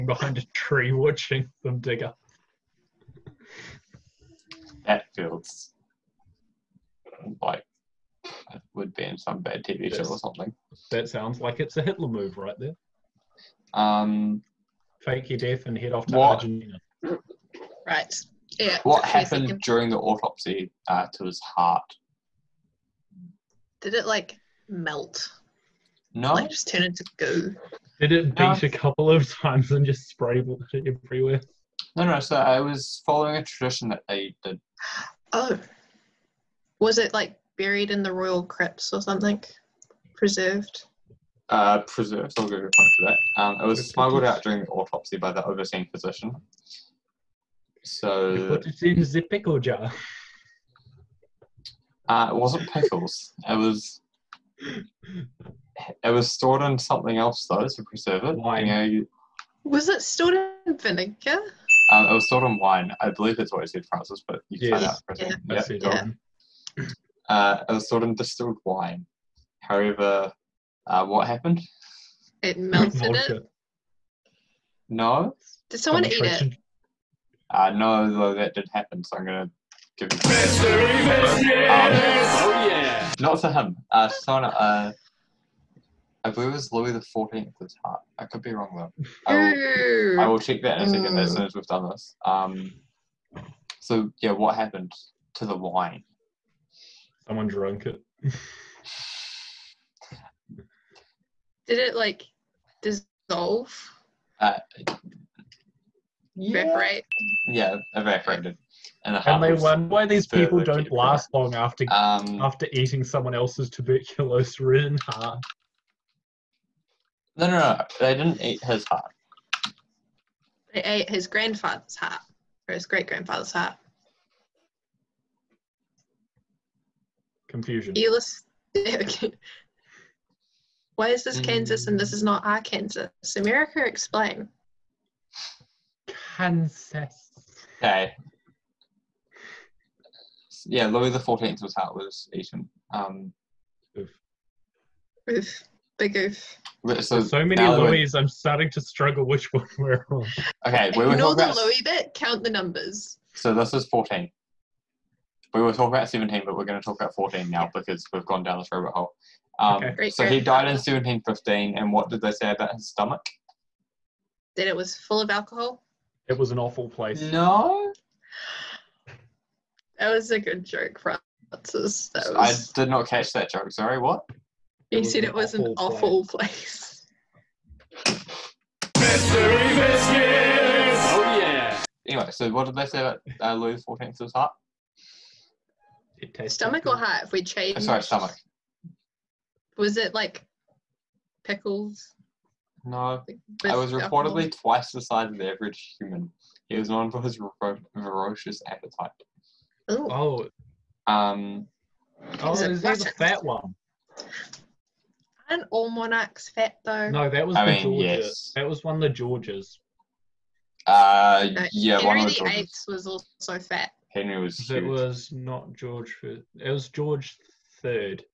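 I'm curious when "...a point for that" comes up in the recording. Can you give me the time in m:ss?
0:42.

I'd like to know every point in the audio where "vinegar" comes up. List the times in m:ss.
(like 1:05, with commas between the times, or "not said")
1:00.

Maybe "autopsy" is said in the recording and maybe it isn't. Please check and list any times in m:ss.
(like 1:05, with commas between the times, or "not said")
0:19, 0:44.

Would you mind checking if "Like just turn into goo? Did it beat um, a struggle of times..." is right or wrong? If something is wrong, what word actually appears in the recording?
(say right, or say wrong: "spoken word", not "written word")
wrong: "couple", not "struggle".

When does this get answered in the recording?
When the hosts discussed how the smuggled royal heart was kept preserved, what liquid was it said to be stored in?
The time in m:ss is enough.
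1:08.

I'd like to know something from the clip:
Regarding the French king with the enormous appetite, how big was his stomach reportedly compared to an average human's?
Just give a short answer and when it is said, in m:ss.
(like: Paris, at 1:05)
twice the size, at 3:14.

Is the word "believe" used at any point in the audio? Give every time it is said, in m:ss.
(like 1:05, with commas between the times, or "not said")
1:03, 1:26.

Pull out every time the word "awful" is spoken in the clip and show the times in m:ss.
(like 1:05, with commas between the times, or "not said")
2:46, 2:55.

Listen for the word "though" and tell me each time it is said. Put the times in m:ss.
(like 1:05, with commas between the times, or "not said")
0:57, 1:18, 1:28, 3:26.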